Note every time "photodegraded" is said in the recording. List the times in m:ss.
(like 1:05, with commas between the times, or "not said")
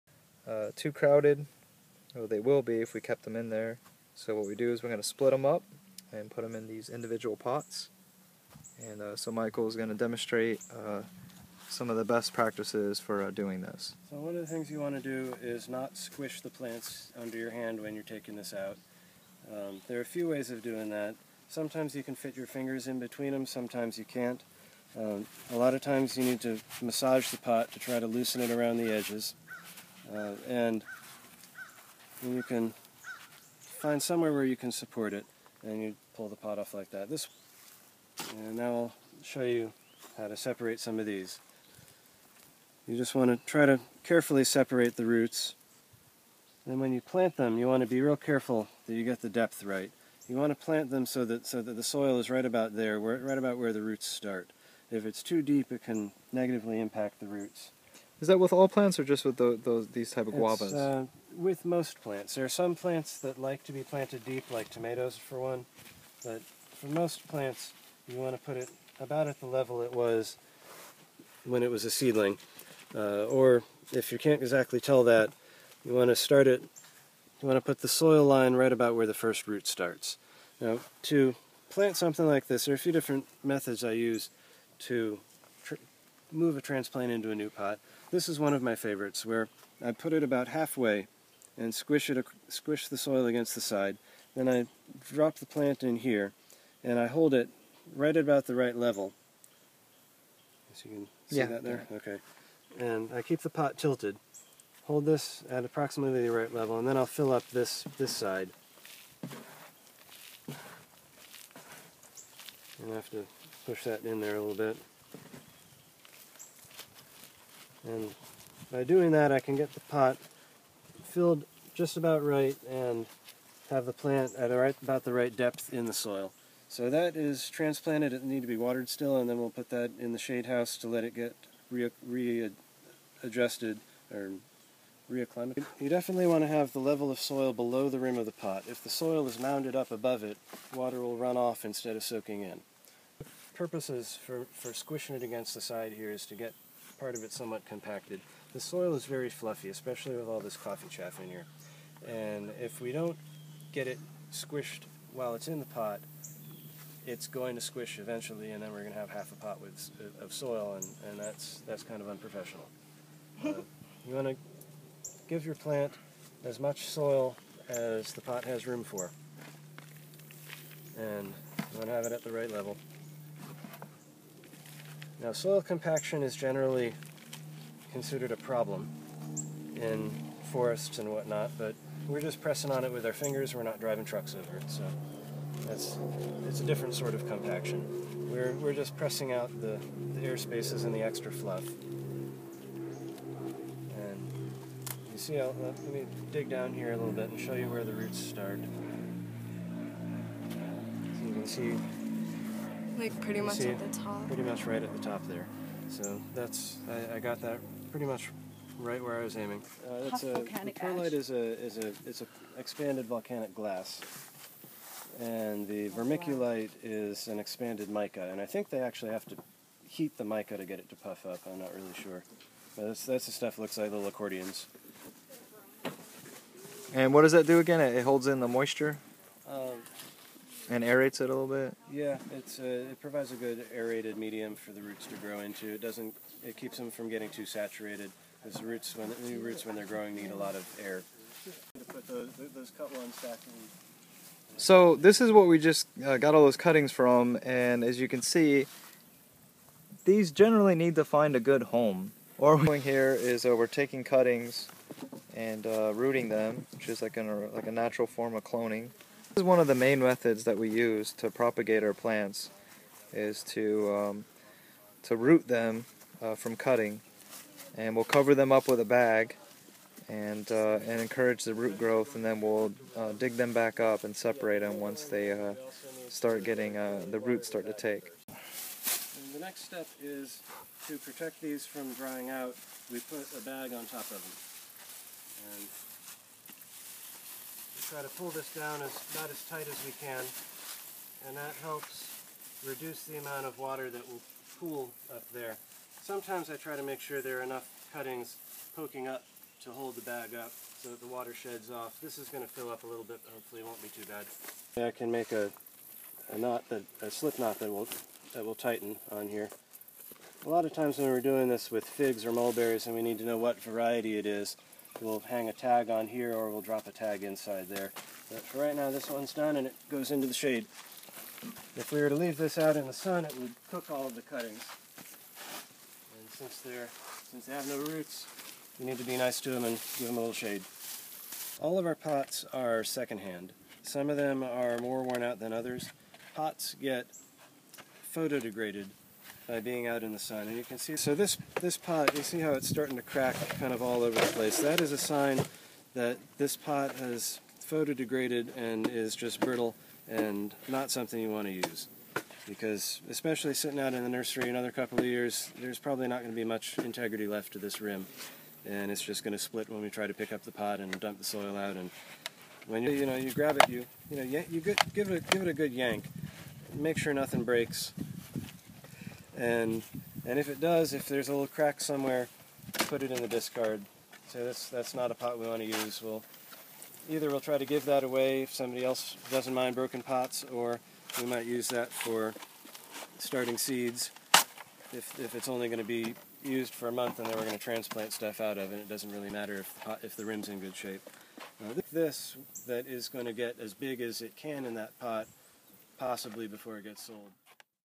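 5:38, 5:47.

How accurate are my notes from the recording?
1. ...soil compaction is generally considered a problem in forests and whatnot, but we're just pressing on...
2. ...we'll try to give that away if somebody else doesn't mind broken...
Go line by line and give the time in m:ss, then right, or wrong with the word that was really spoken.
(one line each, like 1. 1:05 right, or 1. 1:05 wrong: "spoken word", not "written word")
1. 2:55 right
2. 6:17 right.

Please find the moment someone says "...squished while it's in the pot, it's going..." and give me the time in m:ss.
2:34.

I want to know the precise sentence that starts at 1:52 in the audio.
And I have to push that in there a little bit.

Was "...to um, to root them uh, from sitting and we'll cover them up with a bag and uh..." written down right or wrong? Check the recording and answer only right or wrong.
wrong.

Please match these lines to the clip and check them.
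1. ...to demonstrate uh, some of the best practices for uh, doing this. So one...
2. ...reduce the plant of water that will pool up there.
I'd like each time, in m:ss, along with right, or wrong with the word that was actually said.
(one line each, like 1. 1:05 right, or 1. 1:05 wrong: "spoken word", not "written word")
1. 0:09 right
2. 4:52 wrong: "amount", not "plant".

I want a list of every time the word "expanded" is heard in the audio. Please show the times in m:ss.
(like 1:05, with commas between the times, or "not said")
3:32, 3:37.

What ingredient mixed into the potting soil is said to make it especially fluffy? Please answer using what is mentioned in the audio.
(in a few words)
coffee chaff.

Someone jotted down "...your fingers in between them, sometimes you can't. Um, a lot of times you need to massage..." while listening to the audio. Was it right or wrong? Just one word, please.
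right.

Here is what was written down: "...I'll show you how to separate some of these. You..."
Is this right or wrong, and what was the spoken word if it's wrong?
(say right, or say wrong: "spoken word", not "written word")
right.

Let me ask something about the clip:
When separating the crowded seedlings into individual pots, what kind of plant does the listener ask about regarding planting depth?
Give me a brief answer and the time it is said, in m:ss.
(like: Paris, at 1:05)
guavas, at 1:00.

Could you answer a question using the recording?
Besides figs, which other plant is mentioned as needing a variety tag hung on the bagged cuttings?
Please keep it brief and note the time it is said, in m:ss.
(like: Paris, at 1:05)
mulberries, at 5:12.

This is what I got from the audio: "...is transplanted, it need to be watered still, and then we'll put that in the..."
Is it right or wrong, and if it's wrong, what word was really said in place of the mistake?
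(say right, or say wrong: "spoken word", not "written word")
right.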